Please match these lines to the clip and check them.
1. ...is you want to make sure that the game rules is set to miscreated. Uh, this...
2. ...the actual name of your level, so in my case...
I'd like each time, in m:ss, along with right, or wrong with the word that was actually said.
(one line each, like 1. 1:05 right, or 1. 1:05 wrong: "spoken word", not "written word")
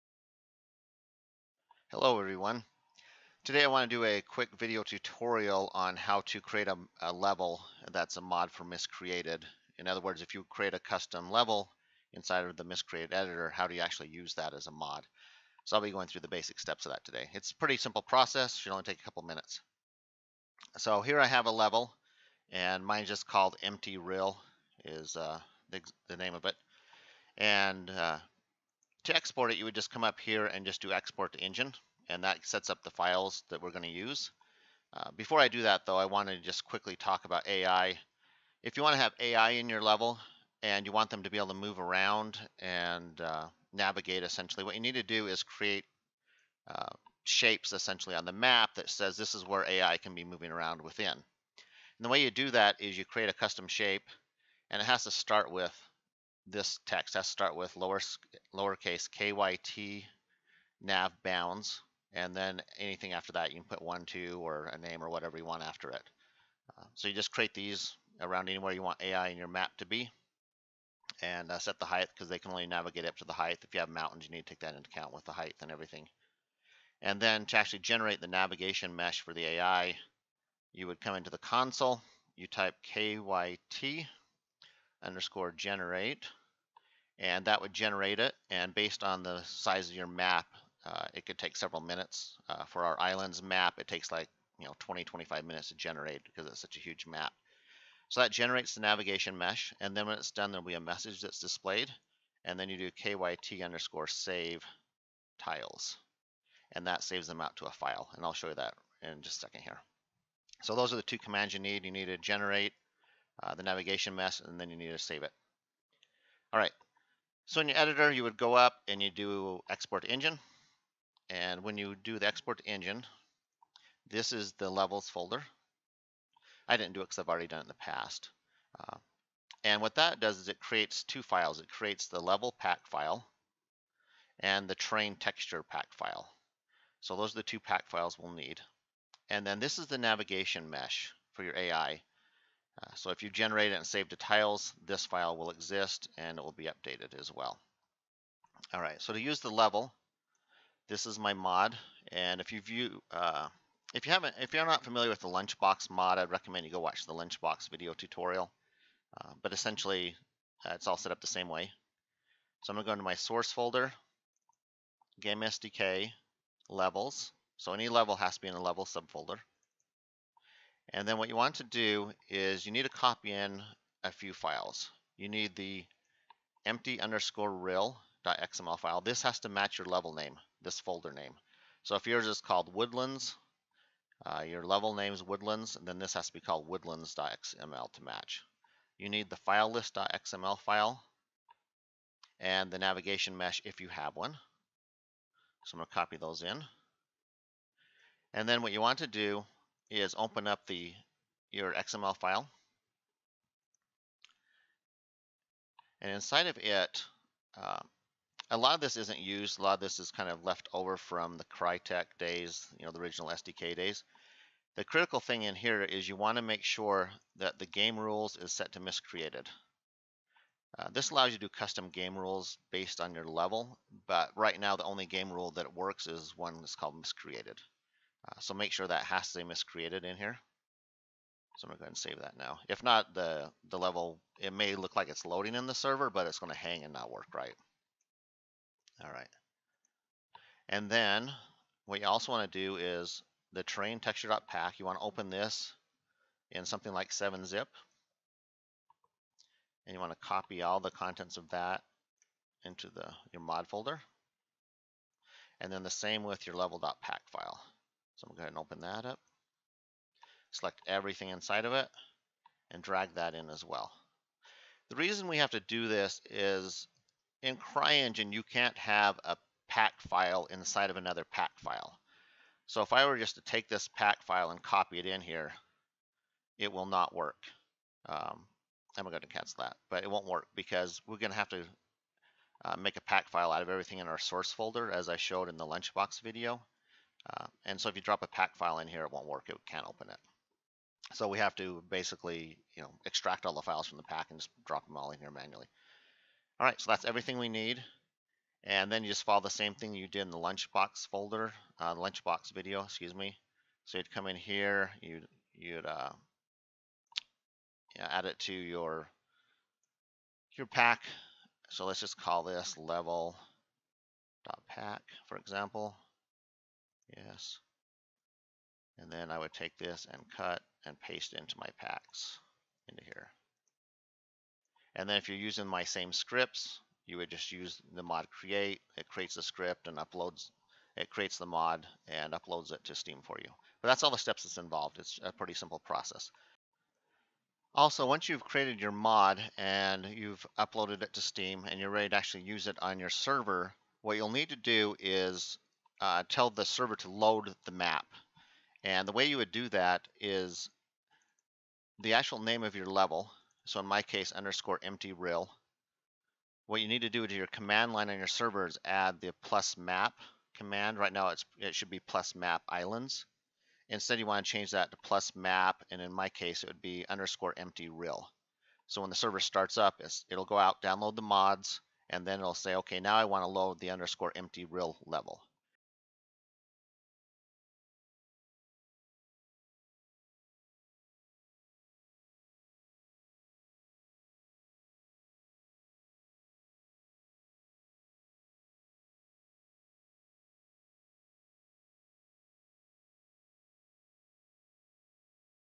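1. 3:35 right
2. 5:52 right.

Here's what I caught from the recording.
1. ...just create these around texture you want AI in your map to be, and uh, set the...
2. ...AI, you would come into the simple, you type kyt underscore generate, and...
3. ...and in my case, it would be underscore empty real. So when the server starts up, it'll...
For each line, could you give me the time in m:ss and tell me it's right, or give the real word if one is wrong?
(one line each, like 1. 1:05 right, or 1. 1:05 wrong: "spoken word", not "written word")
1. 1:07 wrong: "anywhere", not "texture"
2. 1:19 wrong: "console", not "simple"
3. 6:05 right.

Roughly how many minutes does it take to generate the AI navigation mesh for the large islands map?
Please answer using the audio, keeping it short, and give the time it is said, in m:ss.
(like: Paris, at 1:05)
20 to 25 minutes, at 1:34.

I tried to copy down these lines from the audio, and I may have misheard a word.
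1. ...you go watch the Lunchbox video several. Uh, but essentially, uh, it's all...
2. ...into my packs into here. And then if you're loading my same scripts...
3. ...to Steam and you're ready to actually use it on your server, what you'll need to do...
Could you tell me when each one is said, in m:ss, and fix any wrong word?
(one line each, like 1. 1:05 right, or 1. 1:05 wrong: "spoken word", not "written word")
1. 2:36 wrong: "tutorial", not "several"
2. 5:21 wrong: "using", not "loading"
3. 5:41 right.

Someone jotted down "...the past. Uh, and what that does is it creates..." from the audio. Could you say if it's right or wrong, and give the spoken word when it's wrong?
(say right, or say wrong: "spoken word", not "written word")
right.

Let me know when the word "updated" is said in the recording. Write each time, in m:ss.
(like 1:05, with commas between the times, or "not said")
2:26.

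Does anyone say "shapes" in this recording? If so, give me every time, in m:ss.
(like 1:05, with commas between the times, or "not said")
0:47, 0:53.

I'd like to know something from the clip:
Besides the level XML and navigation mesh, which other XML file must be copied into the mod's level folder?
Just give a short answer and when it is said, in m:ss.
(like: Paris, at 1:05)
file list.xml, at 3:09.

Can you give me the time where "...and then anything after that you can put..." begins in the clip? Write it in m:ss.
1:02.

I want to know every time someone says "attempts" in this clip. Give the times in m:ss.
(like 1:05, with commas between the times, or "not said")
not said.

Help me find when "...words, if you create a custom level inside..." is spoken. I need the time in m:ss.
0:09.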